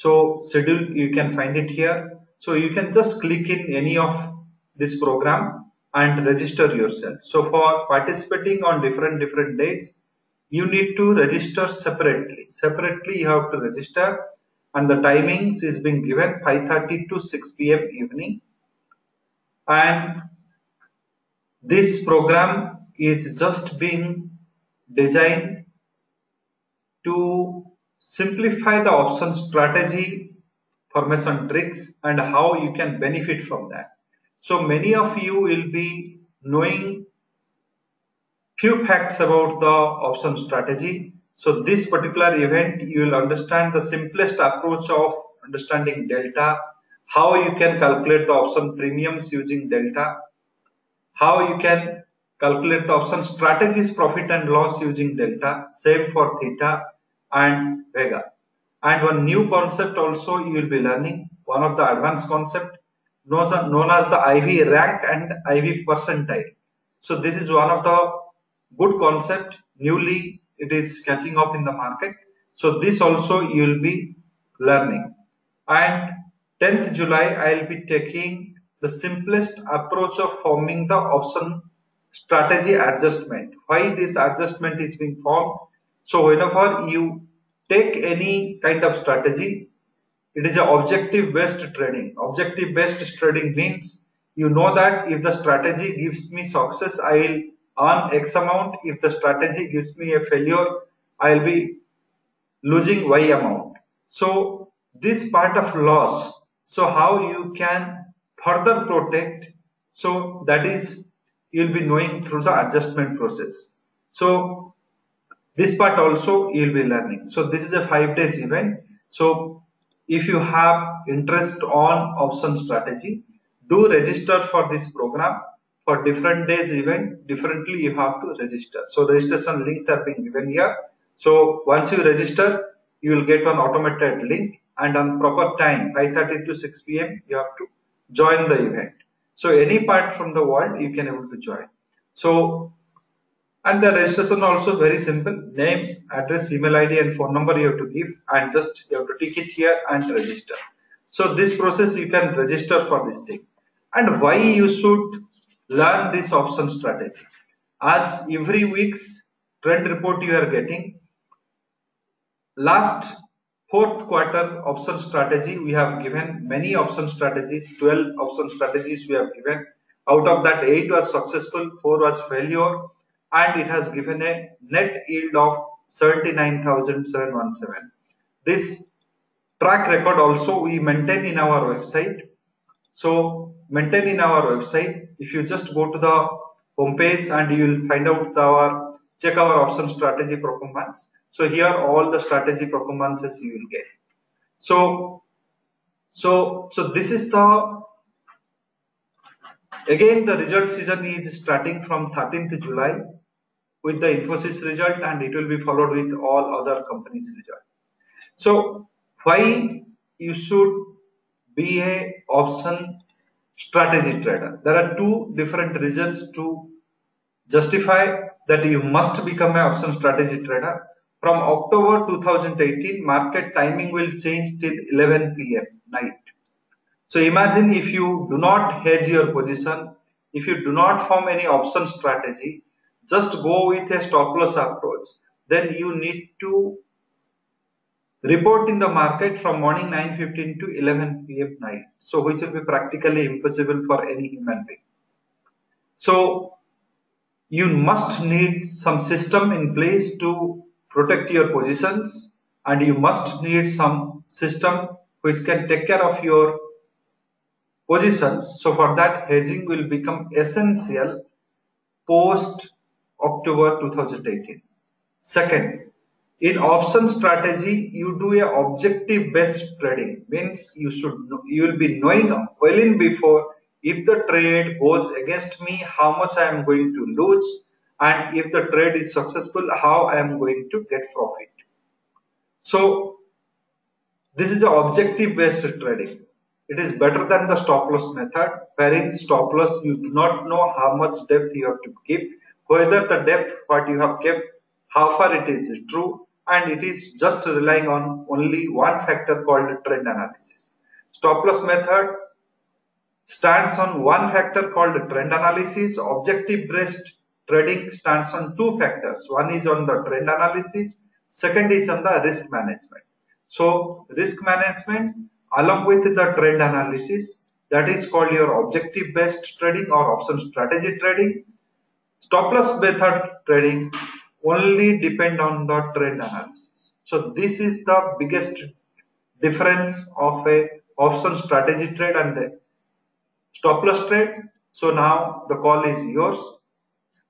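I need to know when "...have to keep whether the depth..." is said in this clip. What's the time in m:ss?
4:51.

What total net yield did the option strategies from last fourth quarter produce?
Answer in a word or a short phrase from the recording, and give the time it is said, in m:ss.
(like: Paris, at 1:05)
79,717, at 2:55.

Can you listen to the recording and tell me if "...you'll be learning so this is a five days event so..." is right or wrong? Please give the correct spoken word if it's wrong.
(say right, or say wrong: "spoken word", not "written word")
right.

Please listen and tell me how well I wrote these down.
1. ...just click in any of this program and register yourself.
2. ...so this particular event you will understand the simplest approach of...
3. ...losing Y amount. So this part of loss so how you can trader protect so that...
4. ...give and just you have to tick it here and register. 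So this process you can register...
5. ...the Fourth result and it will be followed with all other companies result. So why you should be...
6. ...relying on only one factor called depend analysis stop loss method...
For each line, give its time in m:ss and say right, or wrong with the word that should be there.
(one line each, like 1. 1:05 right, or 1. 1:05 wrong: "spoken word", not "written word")
1. 0:02 right
2. 0:41 right
3. 1:42 wrong: "further", not "trader"
4. 2:27 right
5. 3:23 wrong: "Infosys", not "Fourth"
6. 4:57 wrong: "trend", not "depend".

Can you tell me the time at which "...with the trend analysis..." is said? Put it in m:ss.
5:15.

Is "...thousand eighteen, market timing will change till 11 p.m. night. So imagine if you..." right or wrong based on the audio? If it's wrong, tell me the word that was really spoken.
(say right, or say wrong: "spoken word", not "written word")
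right.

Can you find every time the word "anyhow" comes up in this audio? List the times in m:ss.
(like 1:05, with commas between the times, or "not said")
not said.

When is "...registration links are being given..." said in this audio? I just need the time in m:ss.
2:09.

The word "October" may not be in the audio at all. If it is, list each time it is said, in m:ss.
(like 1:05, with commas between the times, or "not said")
3:41, 4:23.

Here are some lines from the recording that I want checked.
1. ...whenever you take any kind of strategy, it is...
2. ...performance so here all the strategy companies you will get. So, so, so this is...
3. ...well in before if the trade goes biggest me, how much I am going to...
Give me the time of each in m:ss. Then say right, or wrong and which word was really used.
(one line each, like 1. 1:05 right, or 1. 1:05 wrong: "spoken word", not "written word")
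1. 1:26 right
2. 3:10 wrong: "performances", not "companies"
3. 4:32 wrong: "against", not "biggest".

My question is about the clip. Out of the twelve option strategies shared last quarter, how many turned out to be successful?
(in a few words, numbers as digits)
8.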